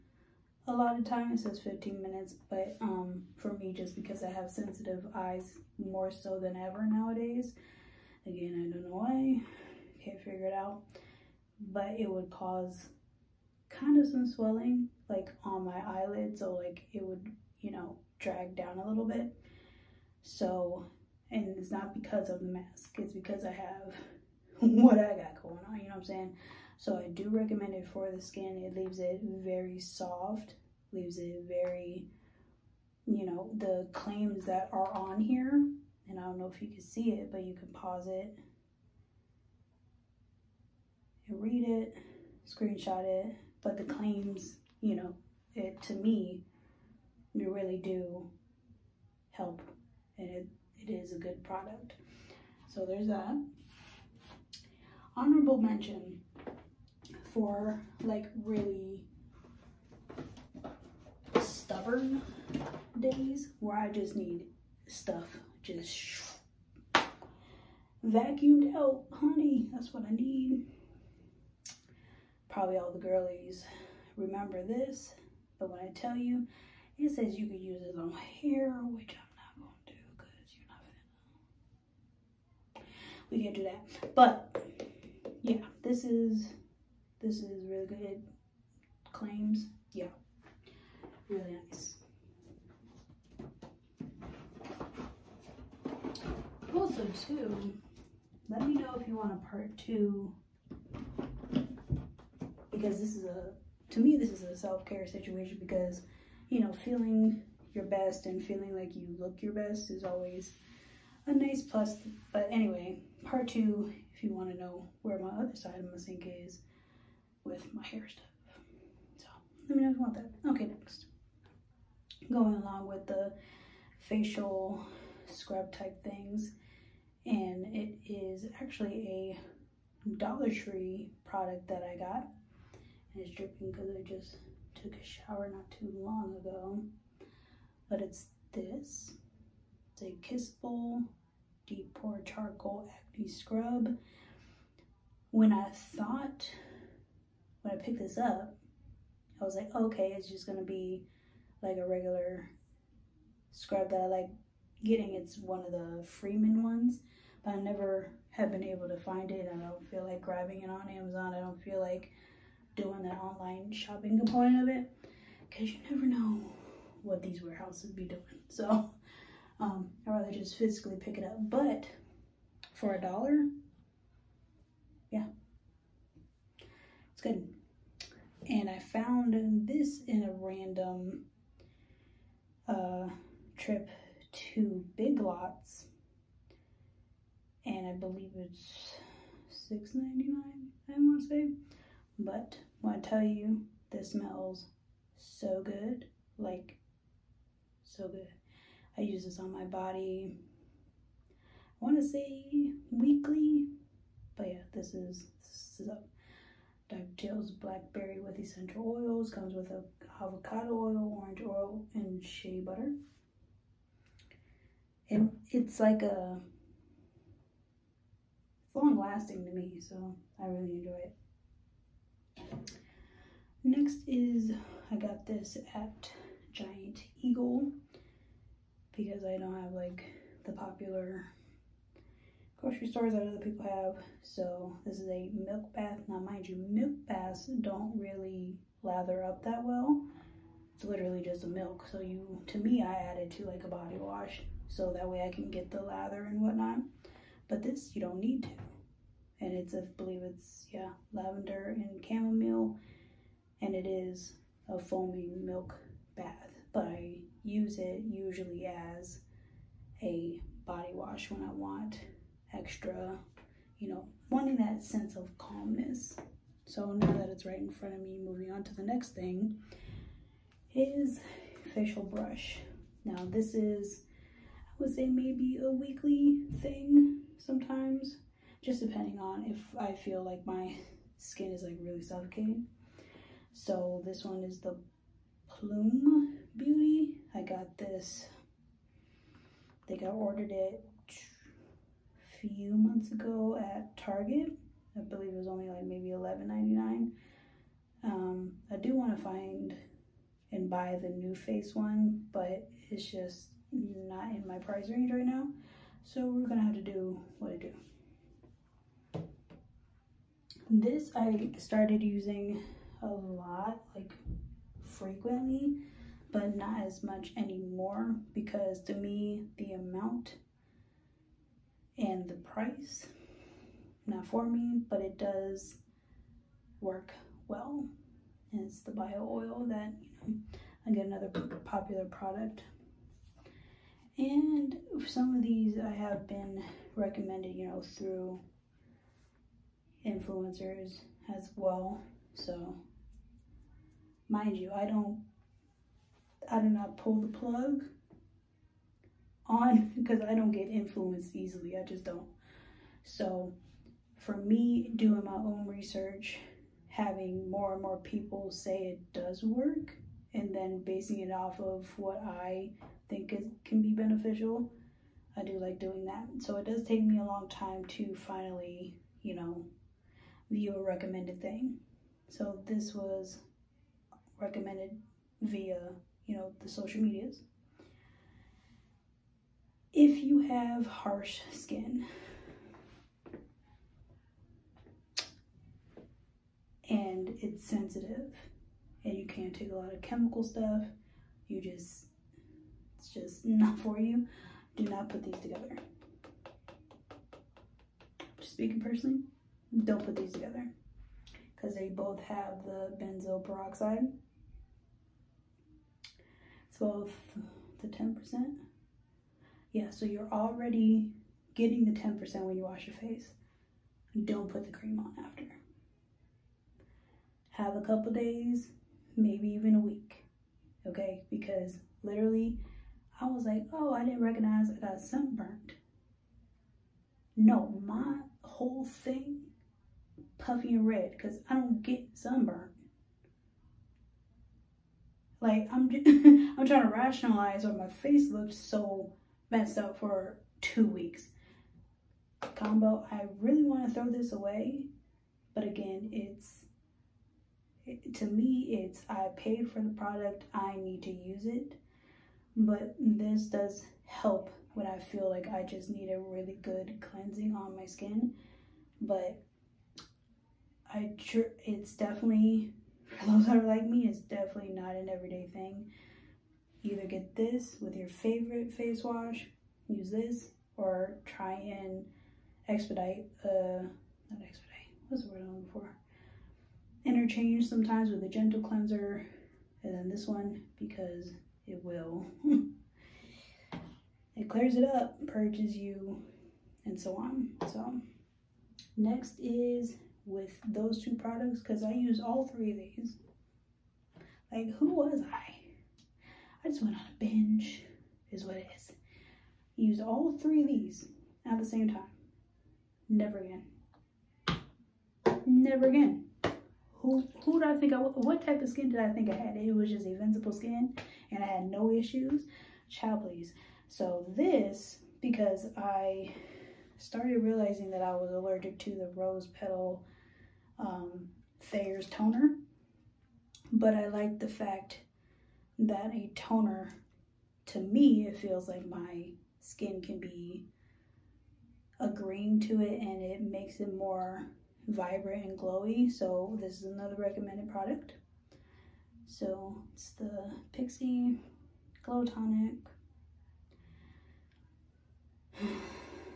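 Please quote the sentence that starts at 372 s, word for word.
So this was recommended via, you know, the social medias if you have harsh skin.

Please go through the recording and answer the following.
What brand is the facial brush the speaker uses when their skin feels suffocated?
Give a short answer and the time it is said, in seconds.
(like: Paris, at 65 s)
Plume Beauty, at 285 s.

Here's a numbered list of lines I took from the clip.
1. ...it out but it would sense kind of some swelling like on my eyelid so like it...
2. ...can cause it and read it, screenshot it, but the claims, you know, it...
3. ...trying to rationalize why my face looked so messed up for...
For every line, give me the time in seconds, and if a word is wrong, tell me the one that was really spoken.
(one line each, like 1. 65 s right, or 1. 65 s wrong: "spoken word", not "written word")
1. 10 s wrong: "cause", not "sense"
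2. 37 s wrong: "pause", not "cause"
3. 436 s right.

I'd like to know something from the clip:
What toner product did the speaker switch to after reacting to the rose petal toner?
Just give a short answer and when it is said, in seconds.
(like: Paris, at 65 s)
Pixie Glow Tonic, at 540 s.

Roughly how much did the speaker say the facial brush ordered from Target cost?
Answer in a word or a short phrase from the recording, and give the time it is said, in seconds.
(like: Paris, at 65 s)
$11.99, at 296 s.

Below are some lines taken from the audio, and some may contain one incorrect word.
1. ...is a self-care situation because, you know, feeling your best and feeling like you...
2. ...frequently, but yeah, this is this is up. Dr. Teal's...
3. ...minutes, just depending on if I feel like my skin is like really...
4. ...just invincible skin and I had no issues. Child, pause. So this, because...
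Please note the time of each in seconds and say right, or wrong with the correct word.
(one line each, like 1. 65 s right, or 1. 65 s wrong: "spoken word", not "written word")
1. 104 s right
2. 202 s wrong: "weekly", not "frequently"
3. 277 s wrong: "sometimes", not "minutes"
4. 509 s wrong: "please", not "pause".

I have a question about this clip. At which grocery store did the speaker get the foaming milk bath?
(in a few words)
Giant Eagle.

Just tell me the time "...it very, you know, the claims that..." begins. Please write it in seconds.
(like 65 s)
31 s.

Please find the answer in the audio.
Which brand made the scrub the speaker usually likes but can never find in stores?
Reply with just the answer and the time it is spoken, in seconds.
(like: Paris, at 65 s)
Freeman, at 156 s.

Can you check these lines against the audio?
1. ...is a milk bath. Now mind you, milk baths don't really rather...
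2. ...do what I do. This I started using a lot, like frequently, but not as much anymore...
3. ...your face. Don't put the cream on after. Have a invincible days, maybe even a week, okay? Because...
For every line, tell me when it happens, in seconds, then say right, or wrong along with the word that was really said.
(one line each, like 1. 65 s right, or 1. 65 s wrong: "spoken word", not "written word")
1. 234 s wrong: "lather", not "rather"
2. 306 s right
3. 412 s wrong: "couple", not "invincible".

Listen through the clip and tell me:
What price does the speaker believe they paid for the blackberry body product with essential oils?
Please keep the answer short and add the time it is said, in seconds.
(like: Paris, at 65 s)
$6.99, at 189 s.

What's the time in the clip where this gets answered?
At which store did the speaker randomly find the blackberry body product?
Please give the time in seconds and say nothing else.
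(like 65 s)
184 s.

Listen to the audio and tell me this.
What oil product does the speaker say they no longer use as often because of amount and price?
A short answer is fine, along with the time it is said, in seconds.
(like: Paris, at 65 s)
Bio Oil, at 328 s.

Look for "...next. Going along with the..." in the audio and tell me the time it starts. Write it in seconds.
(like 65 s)
120 s.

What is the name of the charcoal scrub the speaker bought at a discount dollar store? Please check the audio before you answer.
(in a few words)
Kissable Deep Pore Charcoal Acne Scrub.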